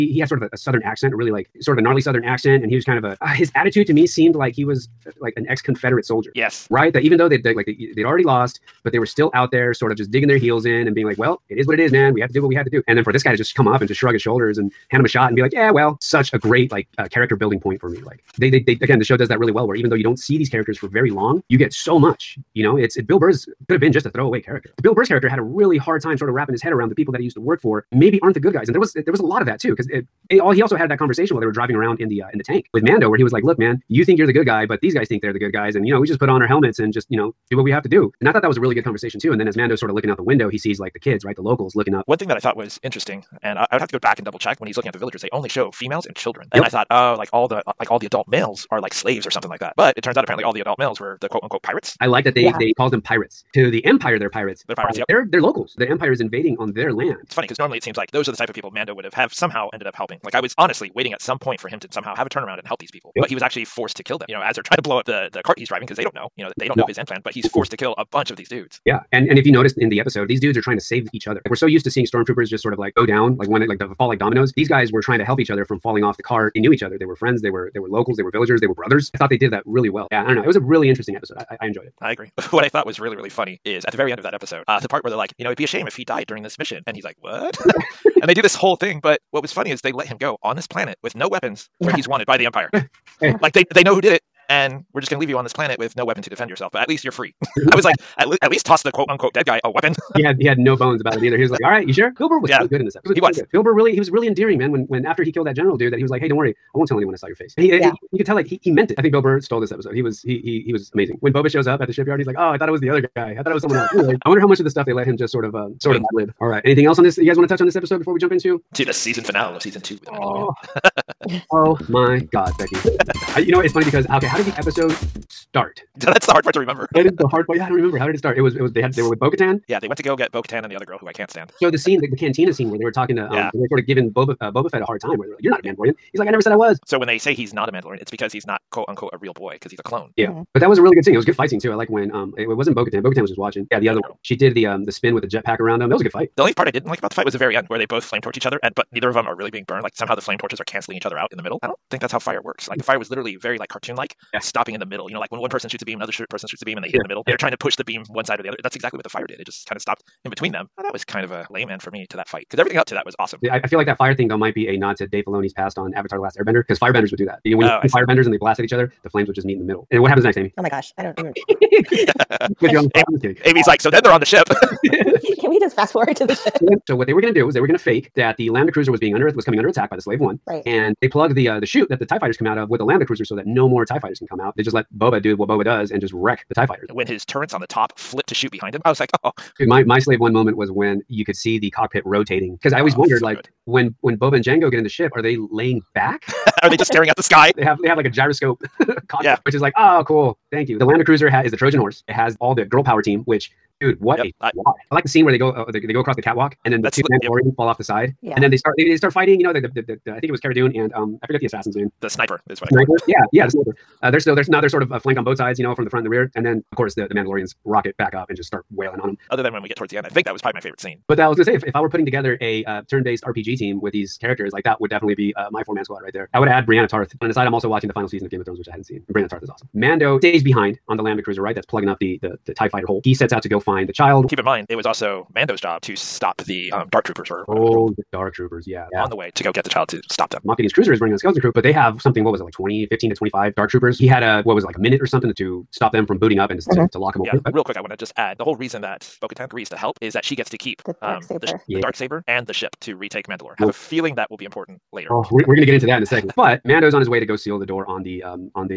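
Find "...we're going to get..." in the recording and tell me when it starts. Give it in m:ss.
4:15.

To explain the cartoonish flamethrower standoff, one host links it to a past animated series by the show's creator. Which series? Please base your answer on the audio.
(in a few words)
Avatar: The Last Airbender.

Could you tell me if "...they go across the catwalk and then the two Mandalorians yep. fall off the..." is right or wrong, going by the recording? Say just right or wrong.
right.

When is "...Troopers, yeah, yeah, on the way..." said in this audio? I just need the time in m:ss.
3:58.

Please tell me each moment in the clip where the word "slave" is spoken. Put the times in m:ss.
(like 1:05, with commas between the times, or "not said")
0:48, 3:00, 3:09.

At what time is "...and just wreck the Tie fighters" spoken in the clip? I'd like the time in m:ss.
3:05.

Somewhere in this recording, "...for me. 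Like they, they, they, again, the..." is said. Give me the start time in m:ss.
0:17.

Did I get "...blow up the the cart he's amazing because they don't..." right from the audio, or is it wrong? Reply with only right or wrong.
wrong.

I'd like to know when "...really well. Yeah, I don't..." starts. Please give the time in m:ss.
1:19.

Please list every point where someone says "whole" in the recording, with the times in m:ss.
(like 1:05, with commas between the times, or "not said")
1:28, 4:08.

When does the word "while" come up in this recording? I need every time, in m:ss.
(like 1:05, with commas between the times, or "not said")
0:31.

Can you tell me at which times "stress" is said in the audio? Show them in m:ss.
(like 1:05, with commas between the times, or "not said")
not said.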